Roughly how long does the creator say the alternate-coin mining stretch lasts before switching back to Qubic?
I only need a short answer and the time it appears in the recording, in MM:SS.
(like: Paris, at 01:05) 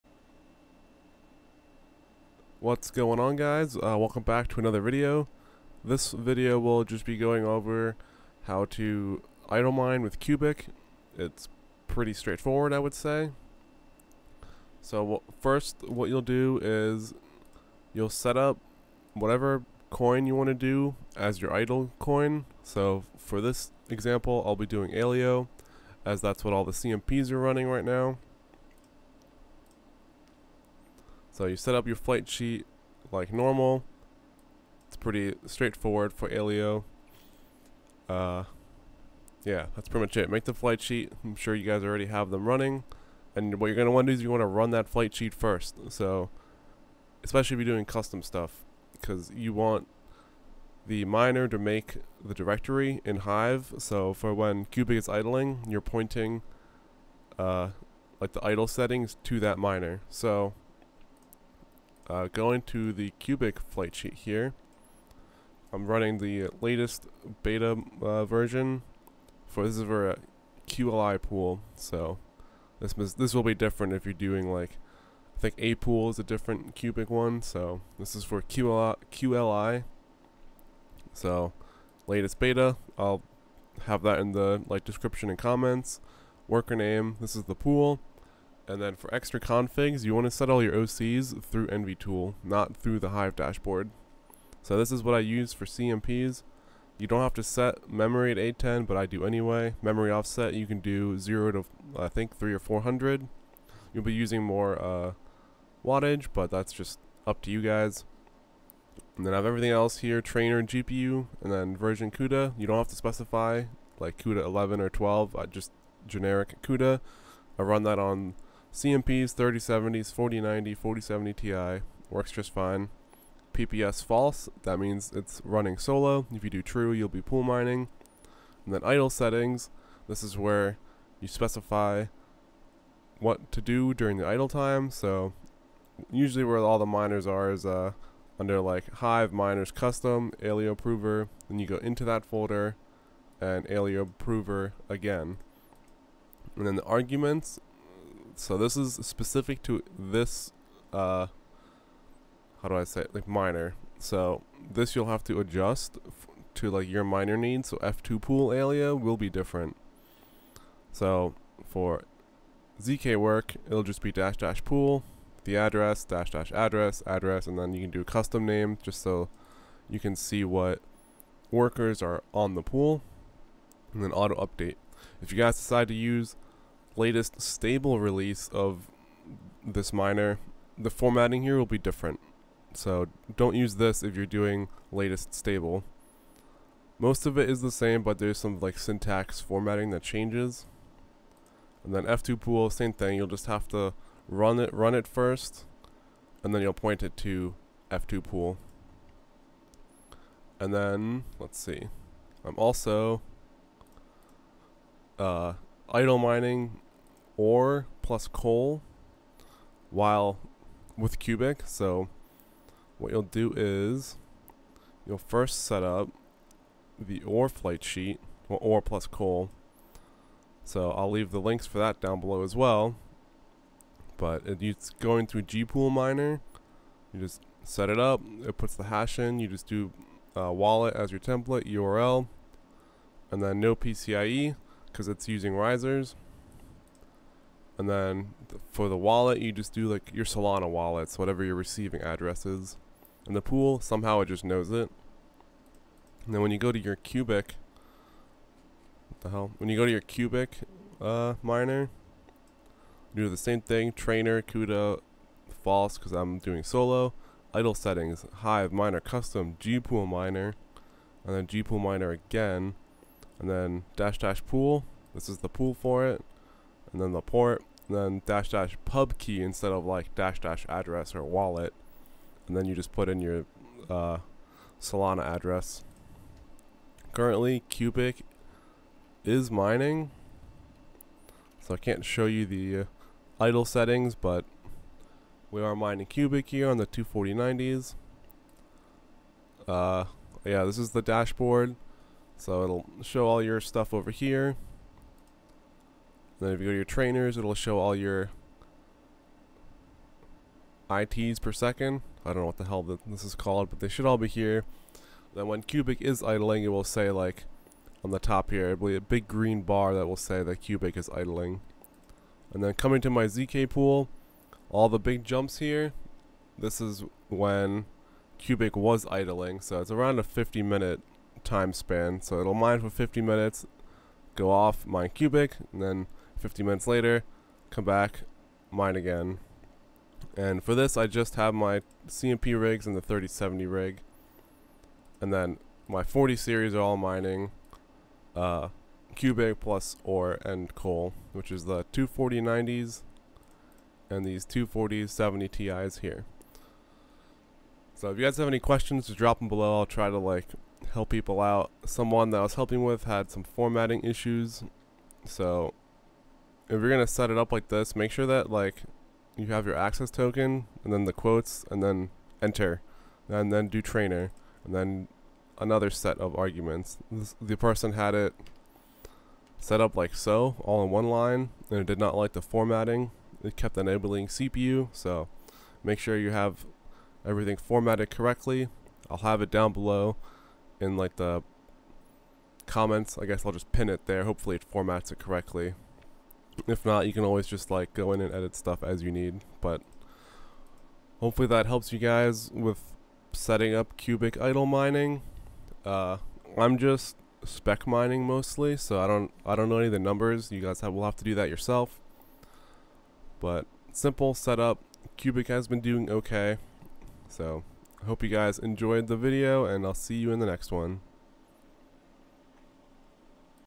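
50 minutes, at 05:20.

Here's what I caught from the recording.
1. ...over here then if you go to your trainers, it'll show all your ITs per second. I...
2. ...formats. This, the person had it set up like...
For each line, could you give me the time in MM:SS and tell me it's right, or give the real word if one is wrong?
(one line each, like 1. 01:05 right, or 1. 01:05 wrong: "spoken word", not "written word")
1. 04:53 right
2. 06:06 wrong: "arguments", not "formats".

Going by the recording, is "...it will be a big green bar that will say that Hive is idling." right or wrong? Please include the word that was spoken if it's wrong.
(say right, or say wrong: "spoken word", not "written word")
wrong: "Qubic", not "Hive".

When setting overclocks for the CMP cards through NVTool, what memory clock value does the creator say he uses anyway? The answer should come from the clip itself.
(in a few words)
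810.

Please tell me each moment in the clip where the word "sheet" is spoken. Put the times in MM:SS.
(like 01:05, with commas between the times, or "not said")
00:32, 00:40, 00:45, 01:03, 03:37.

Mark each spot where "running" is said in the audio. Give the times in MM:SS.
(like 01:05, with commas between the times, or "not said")
00:27, 00:42, 01:05, 02:05.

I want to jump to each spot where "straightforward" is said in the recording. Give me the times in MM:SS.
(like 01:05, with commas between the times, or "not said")
00:12, 00:35.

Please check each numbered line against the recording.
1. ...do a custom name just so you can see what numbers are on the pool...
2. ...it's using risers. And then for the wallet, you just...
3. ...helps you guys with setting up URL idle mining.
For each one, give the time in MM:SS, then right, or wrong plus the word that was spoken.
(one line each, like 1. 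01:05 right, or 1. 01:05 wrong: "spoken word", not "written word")
1. 02:47 wrong: "workers", not "numbers"
2. 03:55 right
3. 06:31 wrong: "Qubic", not "URL".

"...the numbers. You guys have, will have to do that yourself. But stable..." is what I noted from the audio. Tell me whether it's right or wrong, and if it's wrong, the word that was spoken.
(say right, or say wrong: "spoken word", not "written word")
wrong: "simple", not "stable".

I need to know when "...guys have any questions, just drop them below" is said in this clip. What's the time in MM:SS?
05:48.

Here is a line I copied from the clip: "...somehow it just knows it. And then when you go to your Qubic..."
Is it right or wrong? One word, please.
right.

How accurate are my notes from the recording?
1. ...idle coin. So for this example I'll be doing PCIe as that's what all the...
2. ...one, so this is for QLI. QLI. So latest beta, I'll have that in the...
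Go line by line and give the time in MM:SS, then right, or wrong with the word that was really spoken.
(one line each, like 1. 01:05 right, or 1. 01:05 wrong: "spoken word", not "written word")
1. 00:21 wrong: "Aleo", not "PCIe"
2. 01:17 right.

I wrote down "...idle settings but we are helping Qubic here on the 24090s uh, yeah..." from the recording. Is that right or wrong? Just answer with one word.
wrong.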